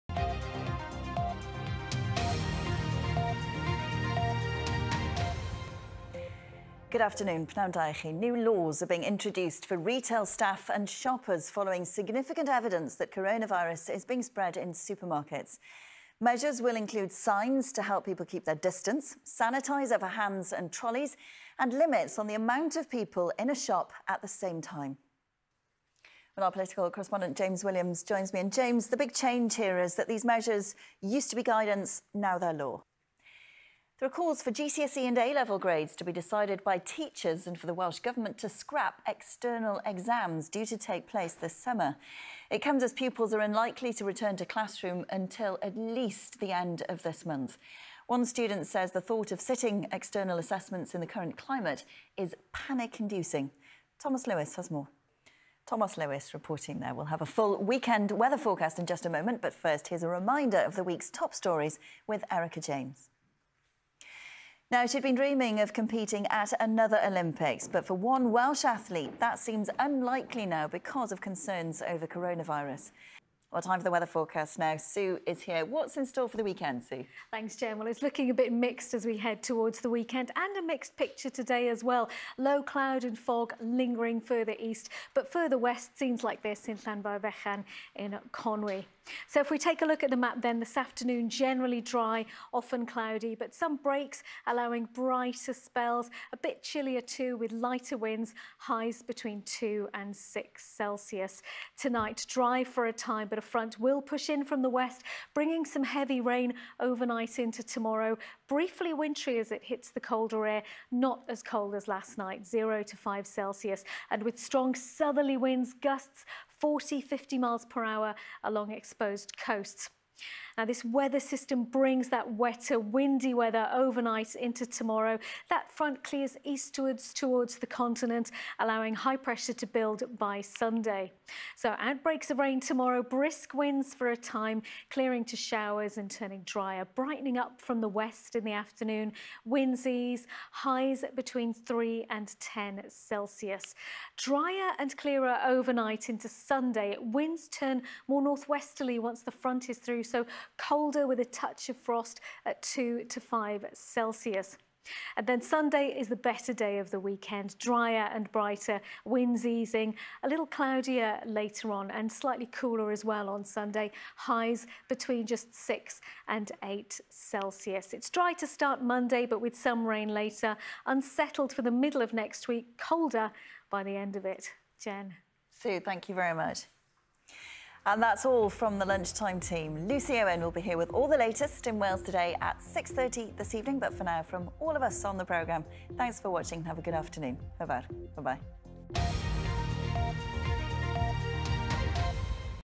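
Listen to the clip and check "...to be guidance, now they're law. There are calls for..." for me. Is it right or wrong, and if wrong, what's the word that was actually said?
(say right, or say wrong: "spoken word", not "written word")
right.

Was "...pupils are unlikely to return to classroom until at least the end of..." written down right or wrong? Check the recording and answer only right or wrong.
right.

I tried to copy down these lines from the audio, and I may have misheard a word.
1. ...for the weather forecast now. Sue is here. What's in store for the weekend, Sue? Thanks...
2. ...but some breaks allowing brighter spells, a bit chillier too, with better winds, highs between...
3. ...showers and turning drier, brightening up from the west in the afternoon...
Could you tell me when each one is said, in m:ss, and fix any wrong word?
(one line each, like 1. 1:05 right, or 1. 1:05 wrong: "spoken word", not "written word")
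1. 1:13 right
2. 1:33 wrong: "lighter", not "better"
3. 2:15 right.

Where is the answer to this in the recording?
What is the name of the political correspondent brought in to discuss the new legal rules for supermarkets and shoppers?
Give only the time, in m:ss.
0:27.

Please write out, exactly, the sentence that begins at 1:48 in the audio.
Briefly wintry as it hits the colder air, not as cold as last night, 0 to 5 Celsius.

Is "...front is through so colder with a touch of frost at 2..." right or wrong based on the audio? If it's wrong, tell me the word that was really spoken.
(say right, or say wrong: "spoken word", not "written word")
right.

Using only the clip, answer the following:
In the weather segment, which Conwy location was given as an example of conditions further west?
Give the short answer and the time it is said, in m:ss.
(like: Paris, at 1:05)
Llanfairfechan, at 1:26.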